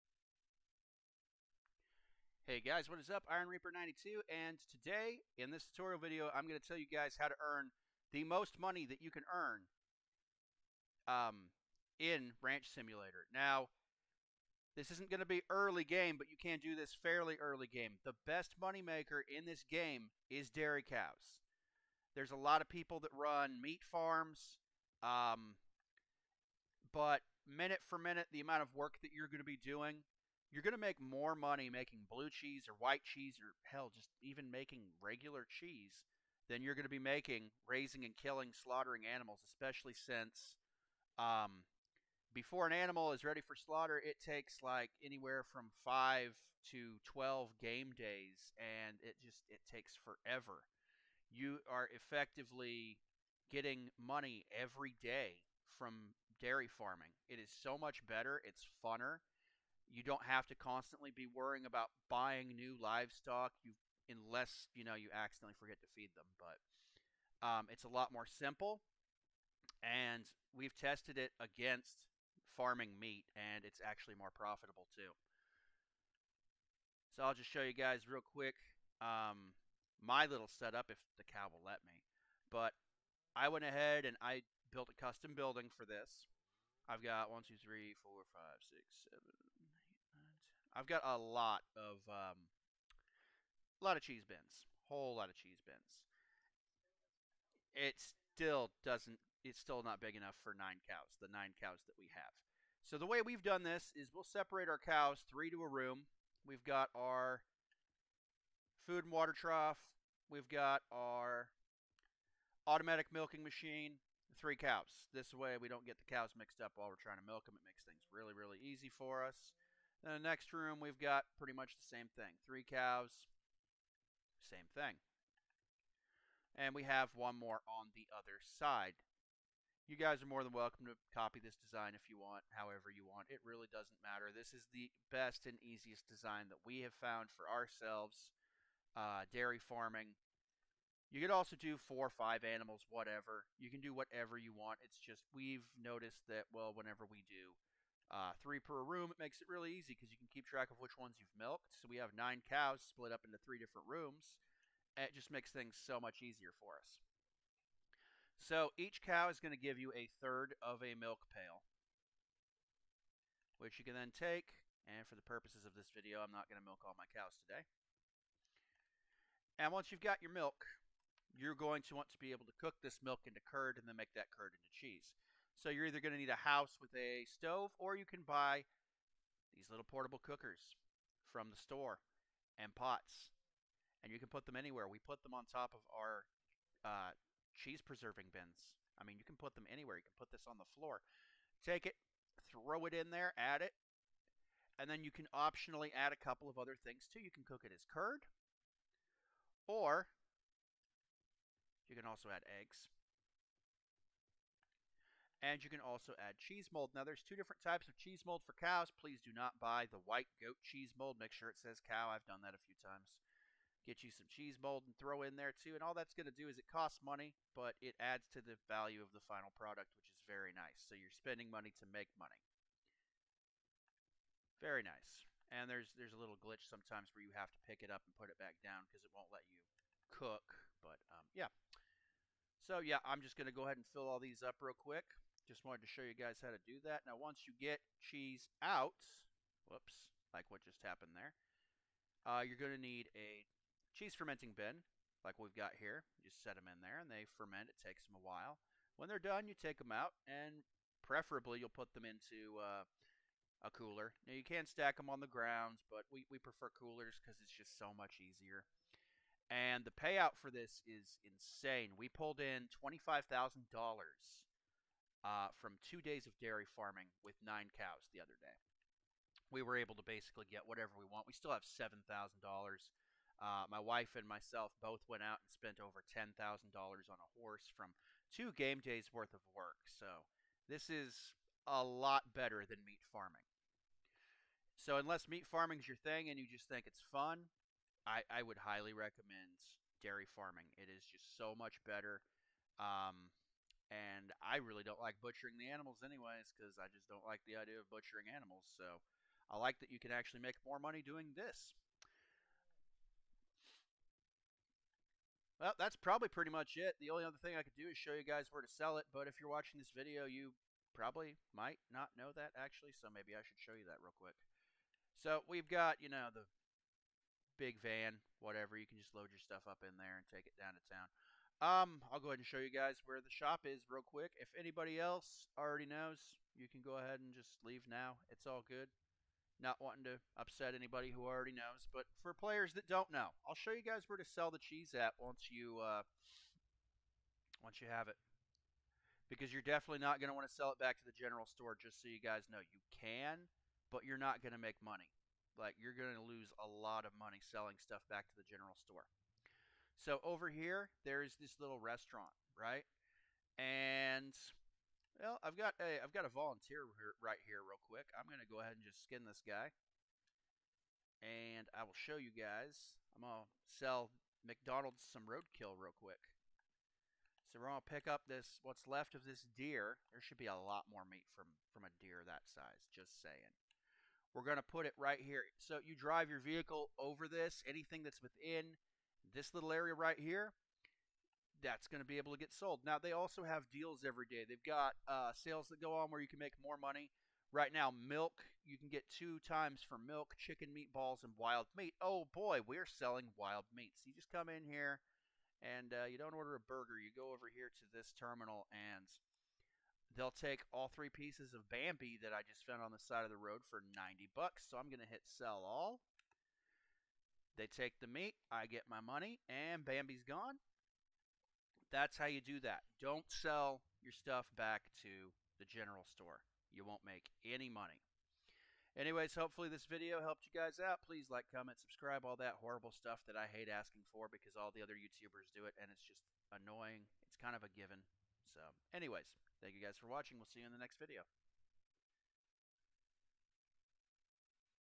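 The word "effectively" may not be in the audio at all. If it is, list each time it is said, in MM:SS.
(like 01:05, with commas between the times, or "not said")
00:51.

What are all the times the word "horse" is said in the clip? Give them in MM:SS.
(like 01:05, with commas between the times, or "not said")
04:37.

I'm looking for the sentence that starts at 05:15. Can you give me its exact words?
So we've got, you know, the big van, whatever.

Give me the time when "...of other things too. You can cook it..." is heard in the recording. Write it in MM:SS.
03:16.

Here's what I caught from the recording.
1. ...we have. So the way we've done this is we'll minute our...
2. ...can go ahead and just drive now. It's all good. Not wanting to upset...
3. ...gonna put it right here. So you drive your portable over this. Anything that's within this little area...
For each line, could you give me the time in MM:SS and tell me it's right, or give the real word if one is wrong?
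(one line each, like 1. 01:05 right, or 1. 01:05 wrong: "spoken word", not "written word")
1. 01:41 wrong: "separate", not "minute"
2. 05:26 wrong: "leave", not "drive"
3. 06:14 wrong: "vehicle", not "portable".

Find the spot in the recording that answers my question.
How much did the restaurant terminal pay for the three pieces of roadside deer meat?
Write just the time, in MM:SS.
06:43.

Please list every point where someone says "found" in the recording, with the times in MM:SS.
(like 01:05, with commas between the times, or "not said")
02:17, 06:42.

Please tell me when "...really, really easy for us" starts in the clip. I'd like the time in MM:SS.
01:58.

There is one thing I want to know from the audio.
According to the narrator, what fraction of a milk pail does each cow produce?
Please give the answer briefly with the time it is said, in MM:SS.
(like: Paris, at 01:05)
a third, at 02:39.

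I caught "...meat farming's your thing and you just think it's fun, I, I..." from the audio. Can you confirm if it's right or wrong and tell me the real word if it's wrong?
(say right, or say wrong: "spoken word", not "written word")
right.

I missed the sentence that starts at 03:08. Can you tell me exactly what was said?
I mean, you can put them anywhere.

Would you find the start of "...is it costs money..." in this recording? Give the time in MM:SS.
03:36.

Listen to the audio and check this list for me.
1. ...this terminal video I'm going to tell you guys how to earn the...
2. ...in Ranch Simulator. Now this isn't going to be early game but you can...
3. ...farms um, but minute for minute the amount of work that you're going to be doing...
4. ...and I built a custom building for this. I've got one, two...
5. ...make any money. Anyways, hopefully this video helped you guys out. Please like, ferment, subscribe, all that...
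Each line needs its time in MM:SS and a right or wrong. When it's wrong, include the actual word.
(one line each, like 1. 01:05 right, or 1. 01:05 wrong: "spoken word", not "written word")
1. 00:05 wrong: "tutorial", not "terminal"
2. 00:11 right
3. 00:23 right
4. 01:24 right
5. 06:57 wrong: "comment", not "ferment".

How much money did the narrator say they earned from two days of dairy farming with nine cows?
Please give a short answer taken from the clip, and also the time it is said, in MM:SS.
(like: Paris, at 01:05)
$25,000, at 04:22.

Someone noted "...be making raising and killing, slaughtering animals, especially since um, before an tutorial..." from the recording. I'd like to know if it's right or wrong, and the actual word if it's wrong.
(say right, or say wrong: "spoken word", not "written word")
wrong: "animal", not "tutorial".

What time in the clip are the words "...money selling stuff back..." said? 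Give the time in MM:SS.
05:47.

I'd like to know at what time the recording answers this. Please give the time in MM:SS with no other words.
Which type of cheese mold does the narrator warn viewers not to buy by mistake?
03:30.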